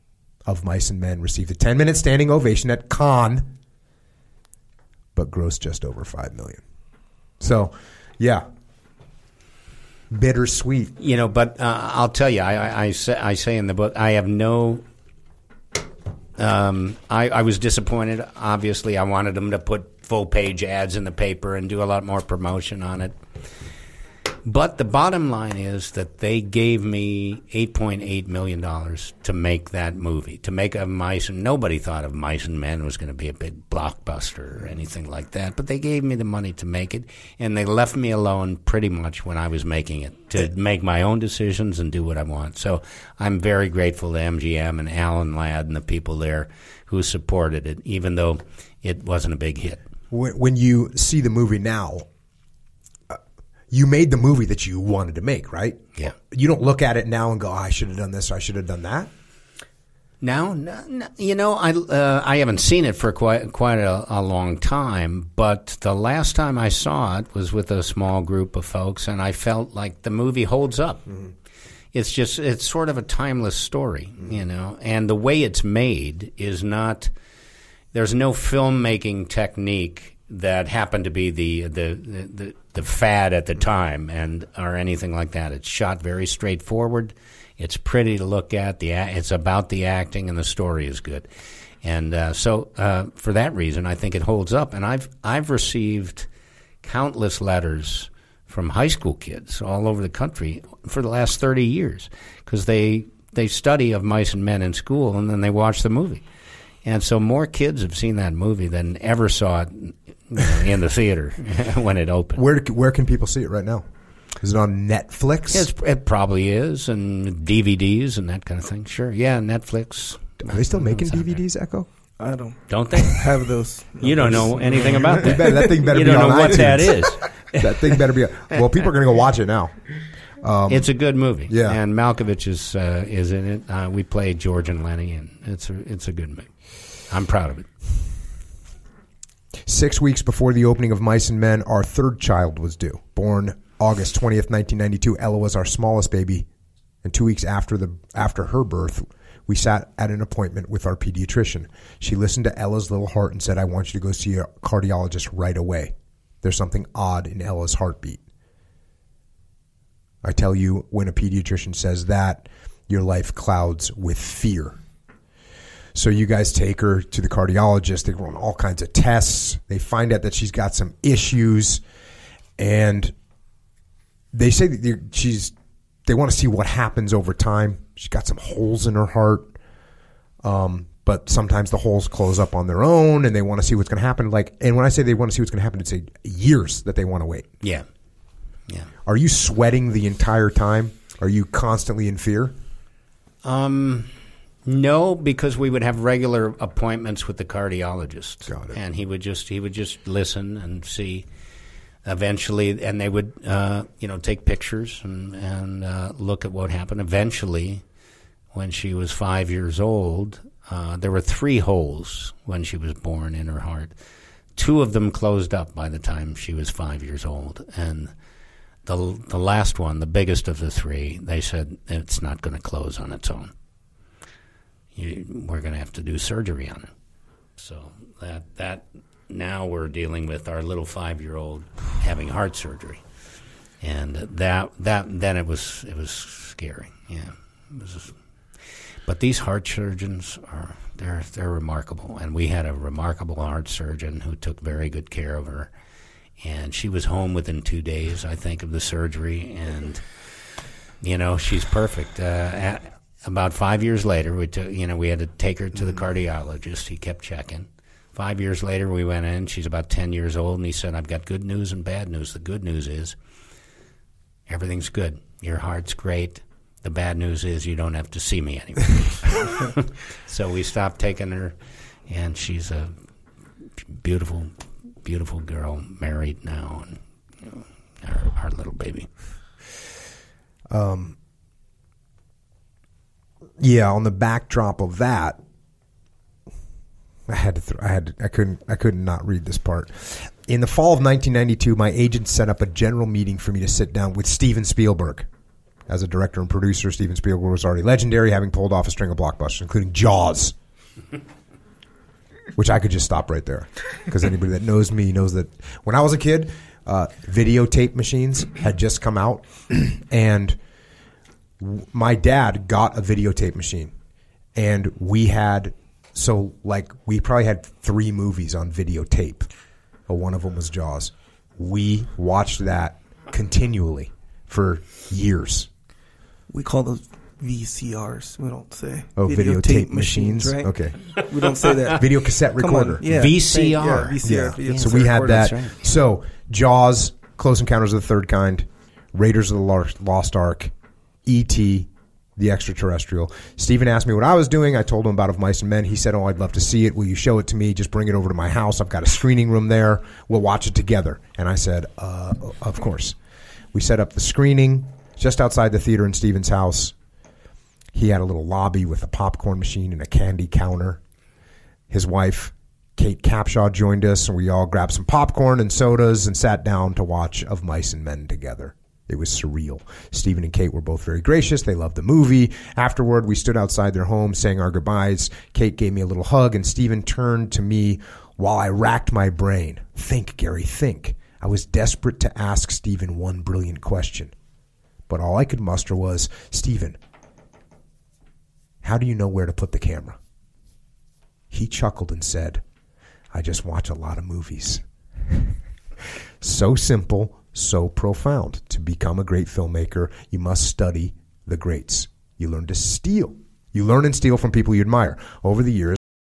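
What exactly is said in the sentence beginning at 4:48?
I could not read this part.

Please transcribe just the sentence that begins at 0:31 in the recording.
And nobody thought of Mice and Men was going to be a big blockbuster or anything like that.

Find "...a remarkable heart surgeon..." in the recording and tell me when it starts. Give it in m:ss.
4:02.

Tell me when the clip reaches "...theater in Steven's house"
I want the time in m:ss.
5:55.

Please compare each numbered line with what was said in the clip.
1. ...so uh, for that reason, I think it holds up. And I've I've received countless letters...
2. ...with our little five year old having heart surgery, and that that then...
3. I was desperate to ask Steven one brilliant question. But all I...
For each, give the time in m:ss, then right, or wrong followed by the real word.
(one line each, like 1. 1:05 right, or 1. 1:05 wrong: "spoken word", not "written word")
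1. 1:32 right
2. 3:50 right
3. 6:21 right.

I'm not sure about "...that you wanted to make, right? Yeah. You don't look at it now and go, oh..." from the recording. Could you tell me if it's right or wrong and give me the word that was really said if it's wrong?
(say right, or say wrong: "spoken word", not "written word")
right.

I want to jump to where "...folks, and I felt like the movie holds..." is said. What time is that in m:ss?
1:08.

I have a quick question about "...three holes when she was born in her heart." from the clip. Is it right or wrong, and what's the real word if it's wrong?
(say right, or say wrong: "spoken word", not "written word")
right.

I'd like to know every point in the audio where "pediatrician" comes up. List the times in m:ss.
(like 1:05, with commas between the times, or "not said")
2:30, 2:41.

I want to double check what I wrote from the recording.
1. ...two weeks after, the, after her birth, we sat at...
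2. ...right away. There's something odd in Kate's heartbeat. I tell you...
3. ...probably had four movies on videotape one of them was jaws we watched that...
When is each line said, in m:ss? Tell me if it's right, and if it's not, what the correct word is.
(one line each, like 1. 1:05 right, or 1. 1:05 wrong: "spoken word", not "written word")
1. 2:27 right
2. 2:35 wrong: "Ella", not "Kate"
3. 5:17 wrong: "three", not "four".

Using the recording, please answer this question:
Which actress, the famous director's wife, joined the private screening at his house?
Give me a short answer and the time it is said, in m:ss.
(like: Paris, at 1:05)
Kate Capshaw, at 6:02.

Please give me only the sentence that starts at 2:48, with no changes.
They run all kinds of tests.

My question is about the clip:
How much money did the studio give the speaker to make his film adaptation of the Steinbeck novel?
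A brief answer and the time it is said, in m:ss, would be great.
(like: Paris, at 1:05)
$8.8 million, at 0:27.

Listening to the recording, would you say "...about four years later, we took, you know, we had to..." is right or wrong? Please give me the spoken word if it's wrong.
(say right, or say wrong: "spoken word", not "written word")
wrong: "five", not "four".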